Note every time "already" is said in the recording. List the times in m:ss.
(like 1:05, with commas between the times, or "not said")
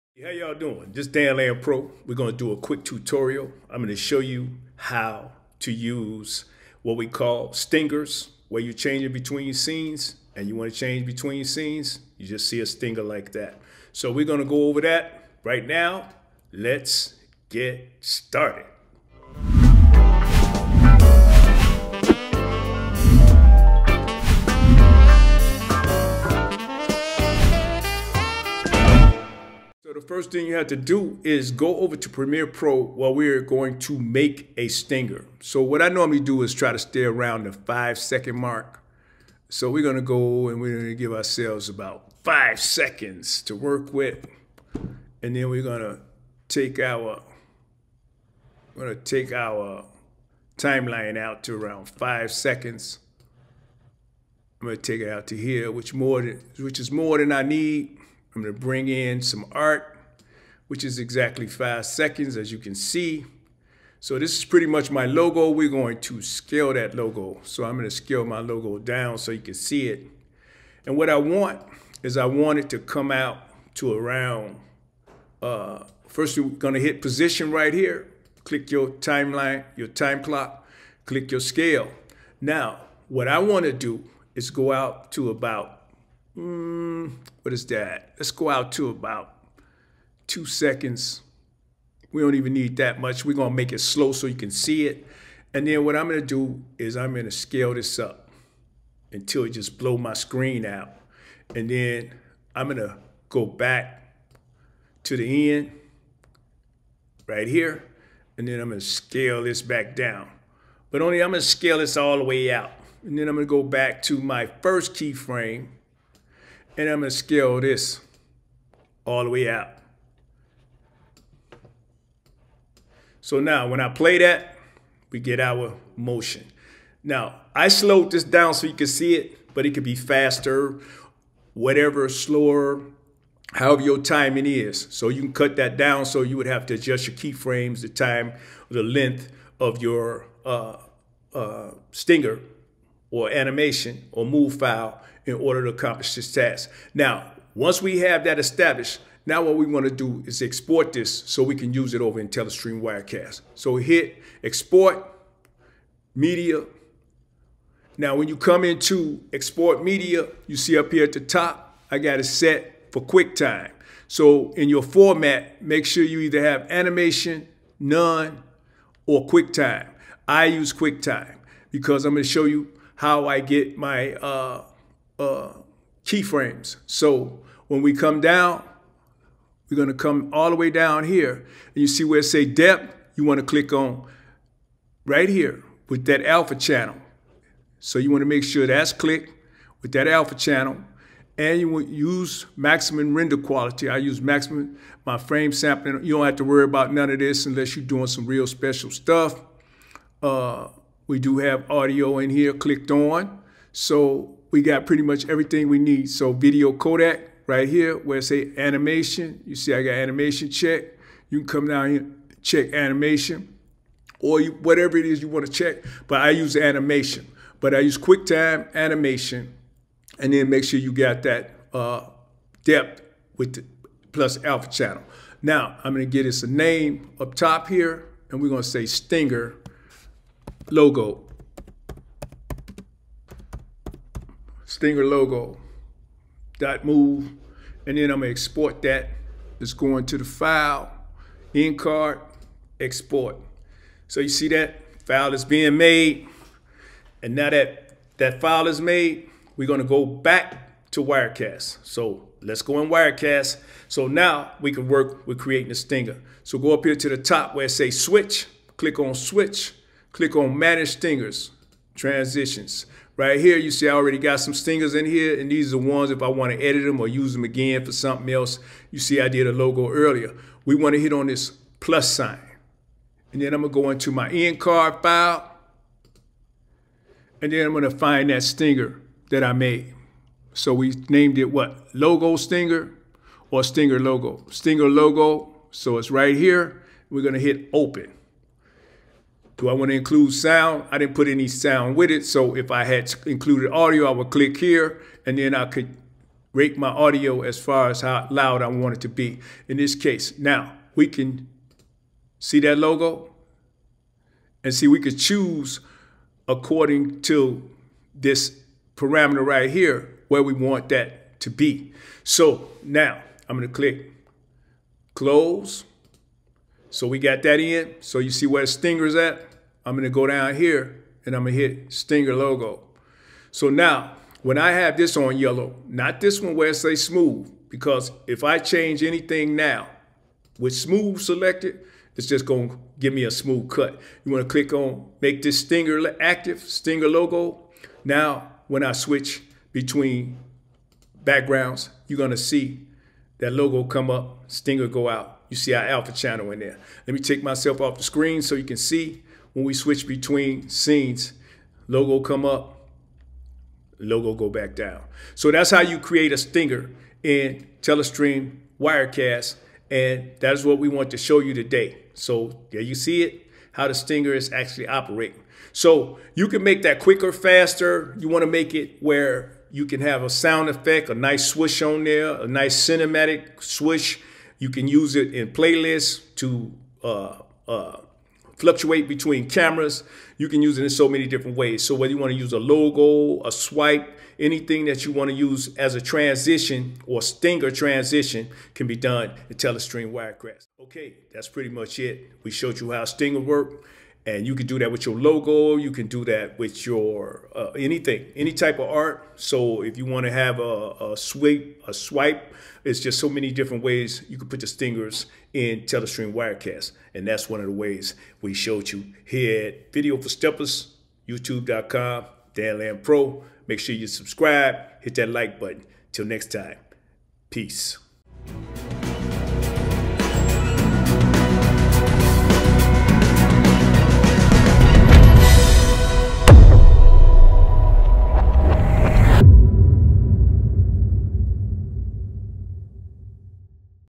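4:23.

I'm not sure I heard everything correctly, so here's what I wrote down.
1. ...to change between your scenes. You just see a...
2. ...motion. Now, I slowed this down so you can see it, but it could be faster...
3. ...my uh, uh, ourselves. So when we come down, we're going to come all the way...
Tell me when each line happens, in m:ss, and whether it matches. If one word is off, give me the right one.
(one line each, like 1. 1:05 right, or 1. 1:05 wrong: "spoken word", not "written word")
1. 0:10 right
2. 2:05 right
3. 2:53 wrong: "keyframes", not "ourselves".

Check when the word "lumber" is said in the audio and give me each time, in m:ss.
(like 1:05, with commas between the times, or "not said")
not said.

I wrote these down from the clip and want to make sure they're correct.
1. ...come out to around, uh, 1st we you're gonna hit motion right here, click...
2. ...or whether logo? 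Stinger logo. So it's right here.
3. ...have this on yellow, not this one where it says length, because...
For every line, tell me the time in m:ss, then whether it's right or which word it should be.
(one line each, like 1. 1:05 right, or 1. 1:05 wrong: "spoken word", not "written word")
1. 1:12 wrong: "position", not "motion"
2. 4:43 wrong: "stinger", not "whether"
3. 5:24 wrong: "smooth", not "length".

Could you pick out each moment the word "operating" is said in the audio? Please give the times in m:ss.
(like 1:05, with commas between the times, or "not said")
6:04.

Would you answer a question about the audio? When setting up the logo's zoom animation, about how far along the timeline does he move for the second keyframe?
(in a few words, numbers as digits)
2 seconds.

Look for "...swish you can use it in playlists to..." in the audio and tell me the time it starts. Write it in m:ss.
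6:13.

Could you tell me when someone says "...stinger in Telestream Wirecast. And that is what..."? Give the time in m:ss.
5:56.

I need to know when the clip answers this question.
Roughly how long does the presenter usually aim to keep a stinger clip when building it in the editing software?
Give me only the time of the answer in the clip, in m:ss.
0:37.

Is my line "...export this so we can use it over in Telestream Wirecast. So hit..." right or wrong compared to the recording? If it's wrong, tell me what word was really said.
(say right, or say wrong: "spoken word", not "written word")
right.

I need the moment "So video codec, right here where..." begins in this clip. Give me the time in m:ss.
3:26.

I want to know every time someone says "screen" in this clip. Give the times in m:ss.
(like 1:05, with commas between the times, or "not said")
1:40, 5:48.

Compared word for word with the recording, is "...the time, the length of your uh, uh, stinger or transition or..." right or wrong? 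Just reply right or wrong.
wrong.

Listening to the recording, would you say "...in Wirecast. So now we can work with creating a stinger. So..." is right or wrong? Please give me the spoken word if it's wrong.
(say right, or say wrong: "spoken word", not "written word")
right.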